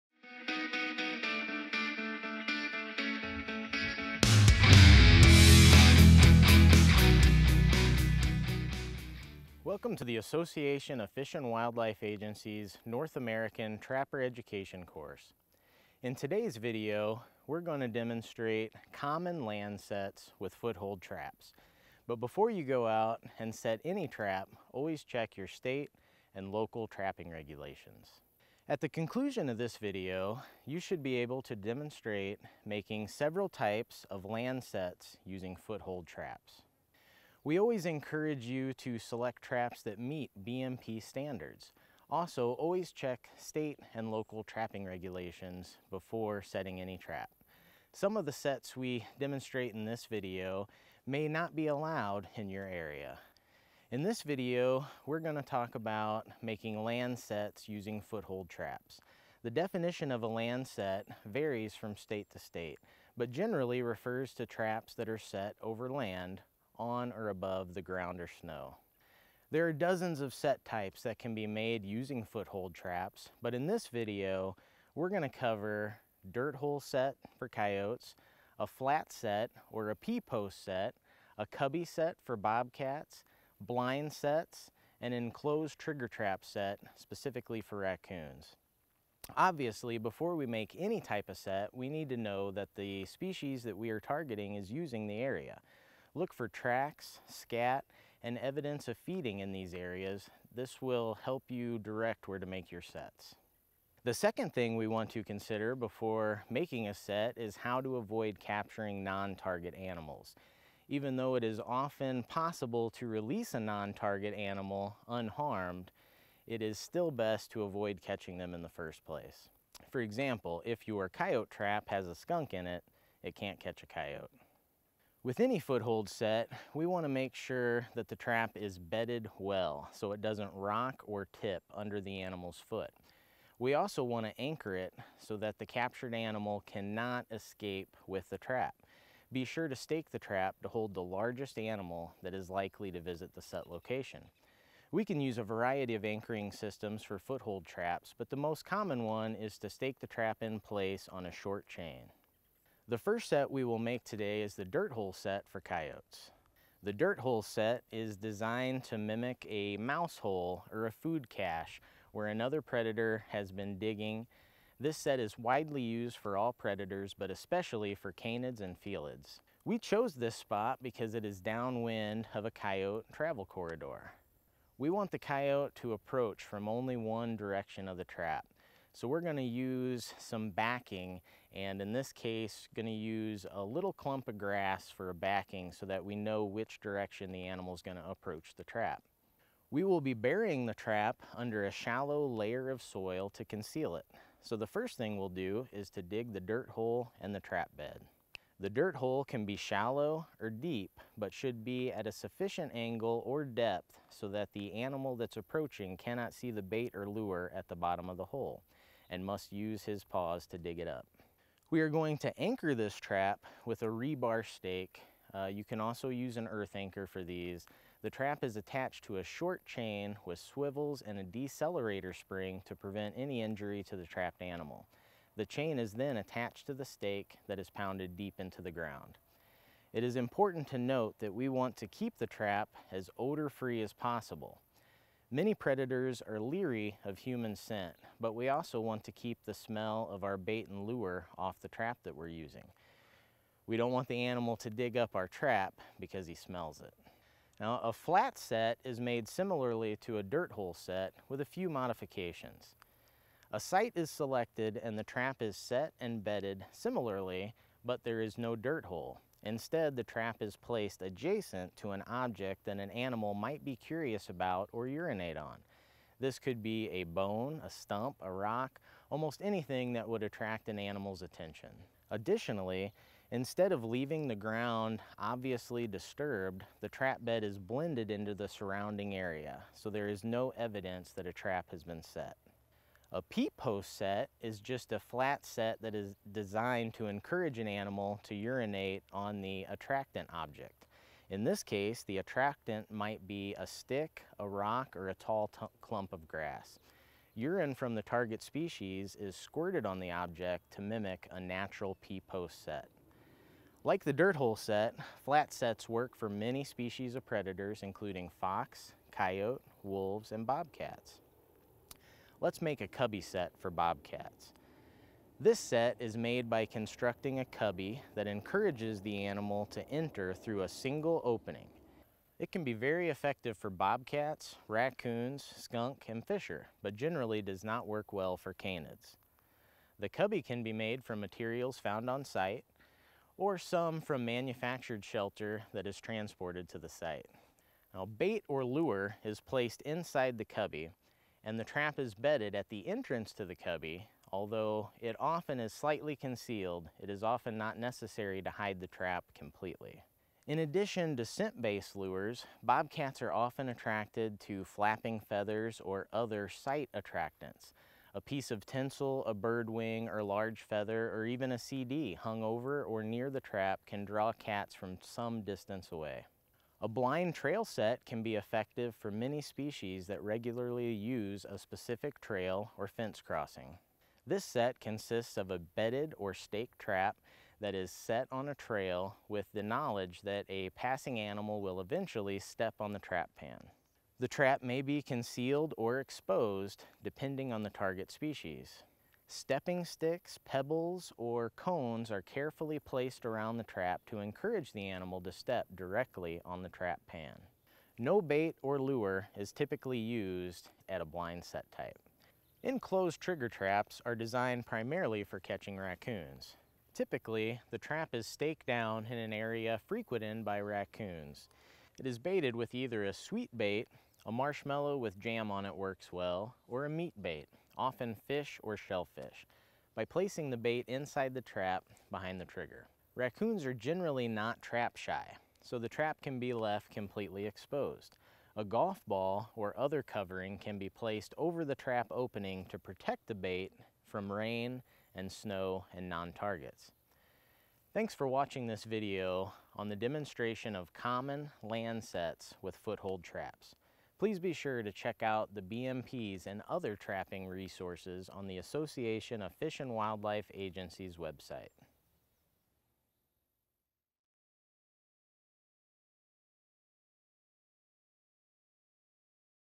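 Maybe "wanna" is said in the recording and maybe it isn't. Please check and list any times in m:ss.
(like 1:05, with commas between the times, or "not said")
2:06, 2:14.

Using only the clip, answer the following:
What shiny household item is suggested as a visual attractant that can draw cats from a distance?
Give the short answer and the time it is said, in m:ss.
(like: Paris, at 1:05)
A CD, at 6:01.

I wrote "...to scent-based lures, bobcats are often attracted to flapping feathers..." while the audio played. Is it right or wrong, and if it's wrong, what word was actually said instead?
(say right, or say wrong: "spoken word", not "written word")
right.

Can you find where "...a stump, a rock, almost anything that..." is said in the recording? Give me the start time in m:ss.
4:27.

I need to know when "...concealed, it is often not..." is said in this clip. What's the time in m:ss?
5:46.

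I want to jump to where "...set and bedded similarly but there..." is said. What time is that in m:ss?
4:15.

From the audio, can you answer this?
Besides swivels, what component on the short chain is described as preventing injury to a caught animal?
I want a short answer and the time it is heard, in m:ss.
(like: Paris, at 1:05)
Decelerator spring, at 3:41.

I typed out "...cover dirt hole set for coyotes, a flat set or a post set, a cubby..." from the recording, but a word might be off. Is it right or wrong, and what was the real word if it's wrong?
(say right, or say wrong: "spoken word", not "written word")
right.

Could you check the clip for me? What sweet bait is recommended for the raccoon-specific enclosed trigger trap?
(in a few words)
Marshmallow with jam.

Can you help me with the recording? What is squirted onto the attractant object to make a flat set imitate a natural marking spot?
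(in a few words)
Urine from the target species.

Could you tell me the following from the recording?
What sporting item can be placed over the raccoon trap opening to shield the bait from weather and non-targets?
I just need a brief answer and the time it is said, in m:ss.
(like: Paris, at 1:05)
Golf ball, at 7:08.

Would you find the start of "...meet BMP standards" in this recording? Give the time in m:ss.
0:39.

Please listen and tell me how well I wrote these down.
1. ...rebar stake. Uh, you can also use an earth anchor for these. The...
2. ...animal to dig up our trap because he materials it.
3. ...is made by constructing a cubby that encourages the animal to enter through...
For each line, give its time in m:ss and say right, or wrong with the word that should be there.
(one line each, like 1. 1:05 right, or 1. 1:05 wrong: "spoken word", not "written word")
1. 3:33 right
2. 4:04 wrong: "smells", not "materials"
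3. 5:15 right.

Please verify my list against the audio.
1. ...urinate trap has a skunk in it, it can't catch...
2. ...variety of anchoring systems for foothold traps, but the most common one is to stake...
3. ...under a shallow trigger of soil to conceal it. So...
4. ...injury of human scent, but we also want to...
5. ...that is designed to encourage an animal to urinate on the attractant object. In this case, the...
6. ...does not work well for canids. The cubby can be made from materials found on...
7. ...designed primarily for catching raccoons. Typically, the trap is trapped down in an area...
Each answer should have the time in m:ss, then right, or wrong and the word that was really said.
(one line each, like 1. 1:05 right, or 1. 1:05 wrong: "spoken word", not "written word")
1. 2:01 wrong: "coyote", not "urinate"
2. 2:25 right
3. 3:11 wrong: "layer", not "trigger"
4. 3:56 wrong: "leery", not "injury"
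5. 4:45 right
6. 5:27 right
7. 6:44 wrong: "staked", not "trapped".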